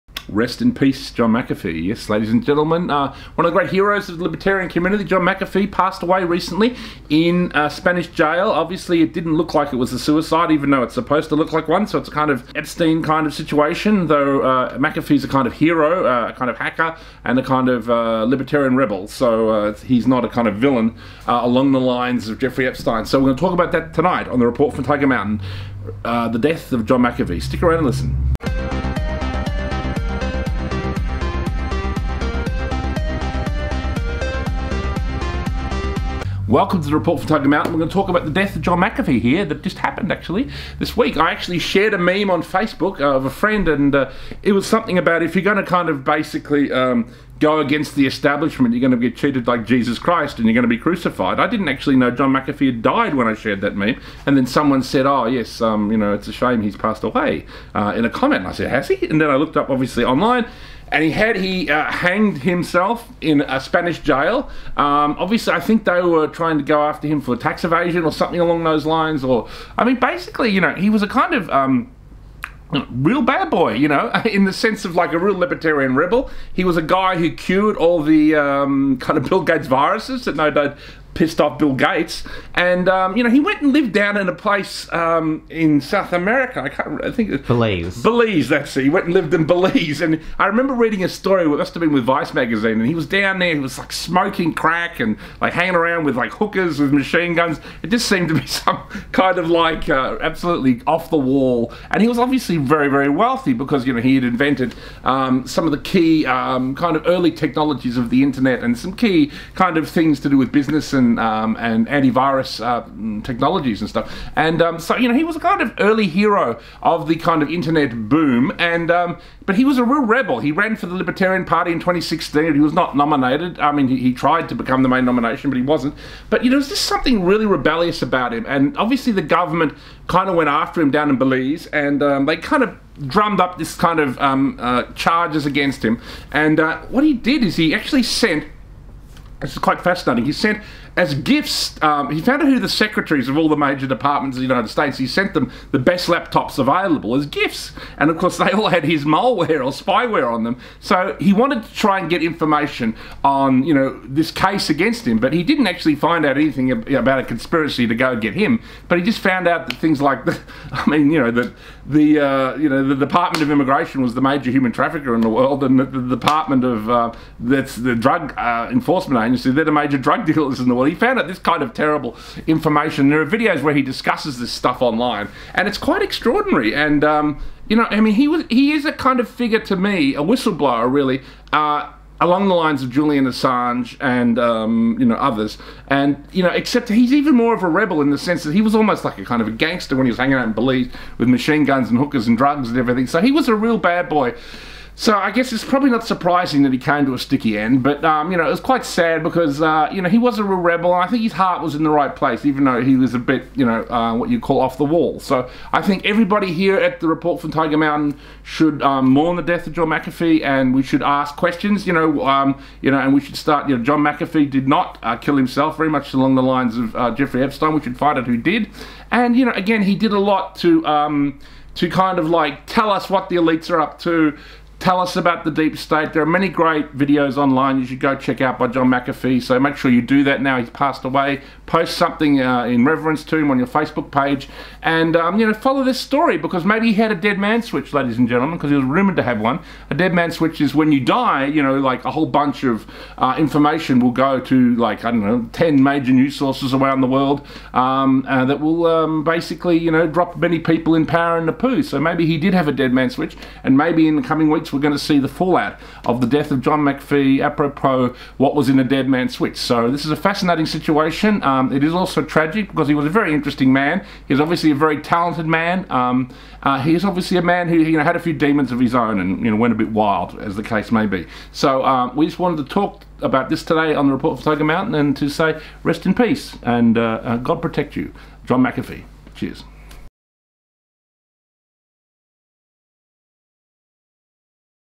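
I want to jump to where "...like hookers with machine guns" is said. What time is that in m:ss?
1:36.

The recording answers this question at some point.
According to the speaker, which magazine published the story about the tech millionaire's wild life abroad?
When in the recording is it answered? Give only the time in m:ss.
1:32.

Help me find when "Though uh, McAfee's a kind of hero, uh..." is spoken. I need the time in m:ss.
0:14.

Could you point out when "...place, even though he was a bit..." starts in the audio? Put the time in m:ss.
3:22.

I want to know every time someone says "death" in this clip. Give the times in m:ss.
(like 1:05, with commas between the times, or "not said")
0:26, 0:38, 3:29, 4:16.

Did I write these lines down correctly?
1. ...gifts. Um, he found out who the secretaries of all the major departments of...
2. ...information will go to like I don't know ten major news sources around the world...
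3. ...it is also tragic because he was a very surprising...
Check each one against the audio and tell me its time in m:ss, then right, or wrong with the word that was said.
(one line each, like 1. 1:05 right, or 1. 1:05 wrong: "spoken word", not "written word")
1. 2:21 right
2. 4:03 right
3. 4:21 wrong: "interesting", not "surprising".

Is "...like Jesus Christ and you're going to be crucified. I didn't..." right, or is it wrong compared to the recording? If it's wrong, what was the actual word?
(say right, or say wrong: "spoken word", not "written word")
right.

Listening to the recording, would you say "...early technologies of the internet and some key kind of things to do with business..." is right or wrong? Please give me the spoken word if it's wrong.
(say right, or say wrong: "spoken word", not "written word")
right.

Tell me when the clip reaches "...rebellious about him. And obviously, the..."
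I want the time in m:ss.
2:07.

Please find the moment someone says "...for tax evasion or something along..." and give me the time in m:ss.
1:07.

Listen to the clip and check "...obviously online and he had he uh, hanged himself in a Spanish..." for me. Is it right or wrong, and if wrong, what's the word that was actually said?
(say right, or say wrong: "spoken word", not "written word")
right.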